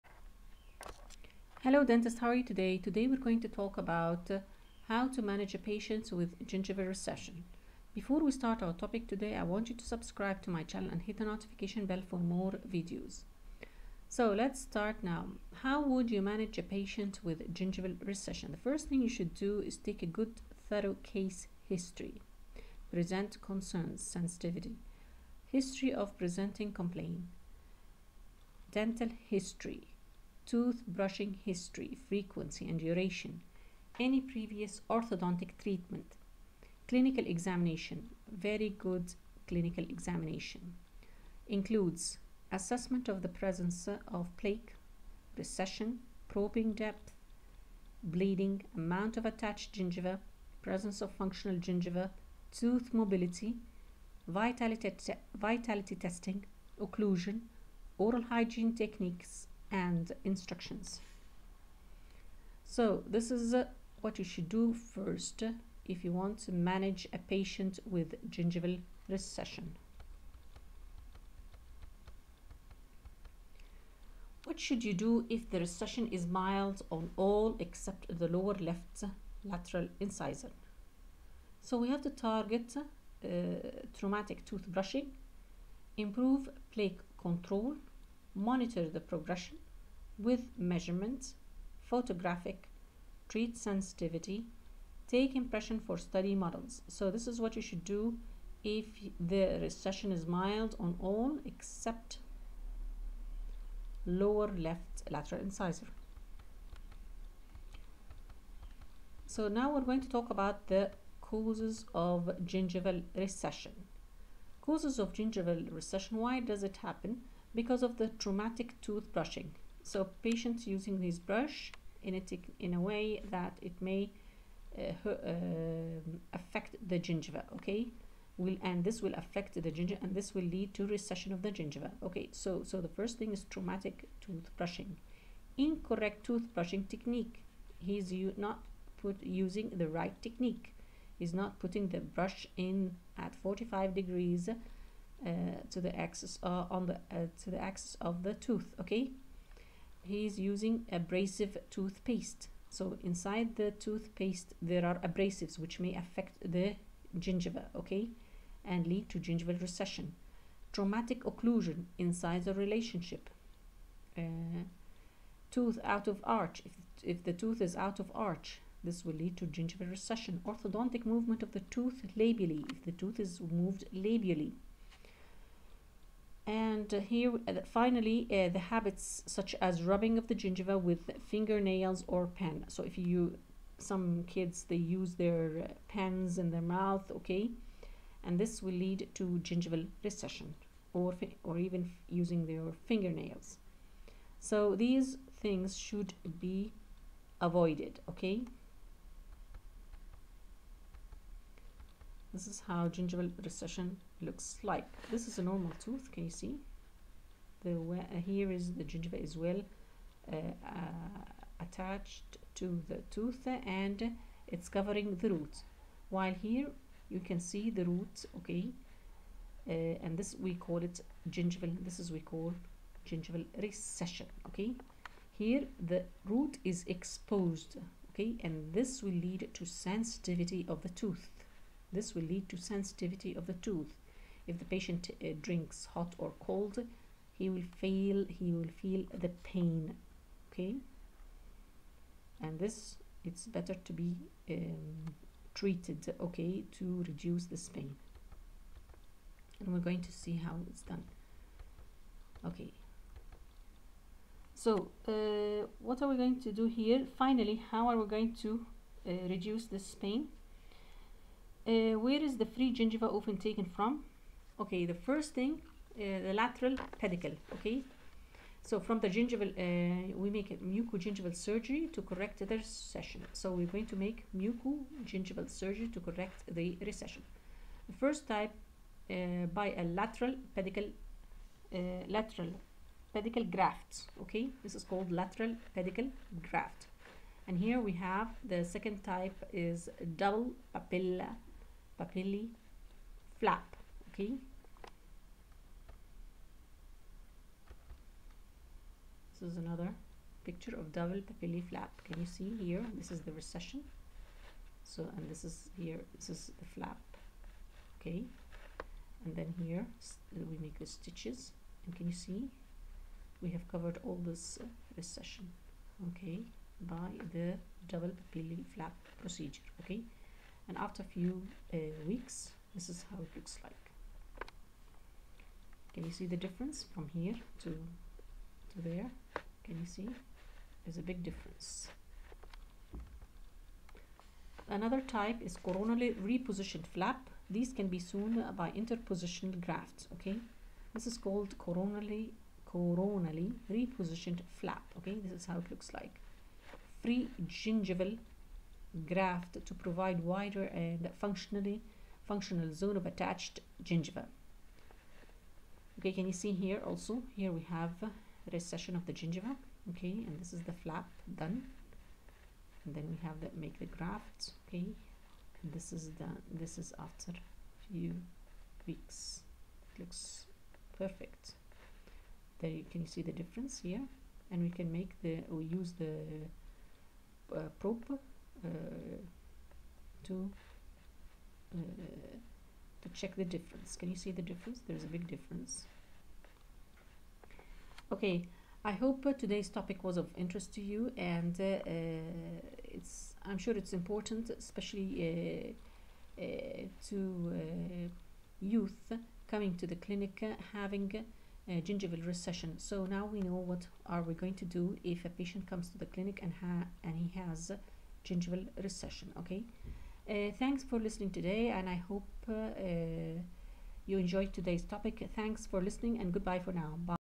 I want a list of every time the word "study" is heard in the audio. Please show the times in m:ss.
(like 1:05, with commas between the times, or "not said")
1:35.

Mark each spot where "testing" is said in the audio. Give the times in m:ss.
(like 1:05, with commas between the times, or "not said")
0:55.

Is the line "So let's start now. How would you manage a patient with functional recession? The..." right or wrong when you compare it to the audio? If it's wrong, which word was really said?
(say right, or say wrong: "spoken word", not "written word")
wrong: "gingival", not "functional".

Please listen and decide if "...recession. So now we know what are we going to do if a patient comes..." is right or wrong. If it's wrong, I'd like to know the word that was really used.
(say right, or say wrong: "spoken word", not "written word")
right.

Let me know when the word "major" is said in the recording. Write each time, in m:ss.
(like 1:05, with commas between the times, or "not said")
not said.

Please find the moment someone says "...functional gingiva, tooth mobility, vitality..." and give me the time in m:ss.
0:51.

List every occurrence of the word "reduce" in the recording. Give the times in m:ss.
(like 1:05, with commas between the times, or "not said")
4:07, 4:19.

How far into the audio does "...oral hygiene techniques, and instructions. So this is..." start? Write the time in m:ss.
0:57.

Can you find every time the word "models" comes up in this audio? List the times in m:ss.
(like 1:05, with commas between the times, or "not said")
1:36.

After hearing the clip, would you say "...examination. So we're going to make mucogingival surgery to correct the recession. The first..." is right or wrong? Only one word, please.
wrong.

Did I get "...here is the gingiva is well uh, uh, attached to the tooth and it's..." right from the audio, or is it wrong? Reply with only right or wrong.
right.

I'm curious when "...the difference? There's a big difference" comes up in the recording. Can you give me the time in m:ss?
6:24.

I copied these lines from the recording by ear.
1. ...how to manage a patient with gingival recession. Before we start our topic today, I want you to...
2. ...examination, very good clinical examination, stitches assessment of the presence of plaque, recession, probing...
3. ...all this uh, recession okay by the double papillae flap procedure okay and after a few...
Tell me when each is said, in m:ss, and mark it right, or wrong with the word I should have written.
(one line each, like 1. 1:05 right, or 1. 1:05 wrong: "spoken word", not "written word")
1. 0:04 right
2. 0:37 wrong: "includes", not "stitches"
3. 5:14 right.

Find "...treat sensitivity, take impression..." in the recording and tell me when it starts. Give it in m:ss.
1:33.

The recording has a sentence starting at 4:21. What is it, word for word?
Uh, where is the free gingiva often taken from?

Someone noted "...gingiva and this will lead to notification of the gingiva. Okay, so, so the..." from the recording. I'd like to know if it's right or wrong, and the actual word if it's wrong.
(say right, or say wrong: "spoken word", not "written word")
wrong: "recession", not "notification".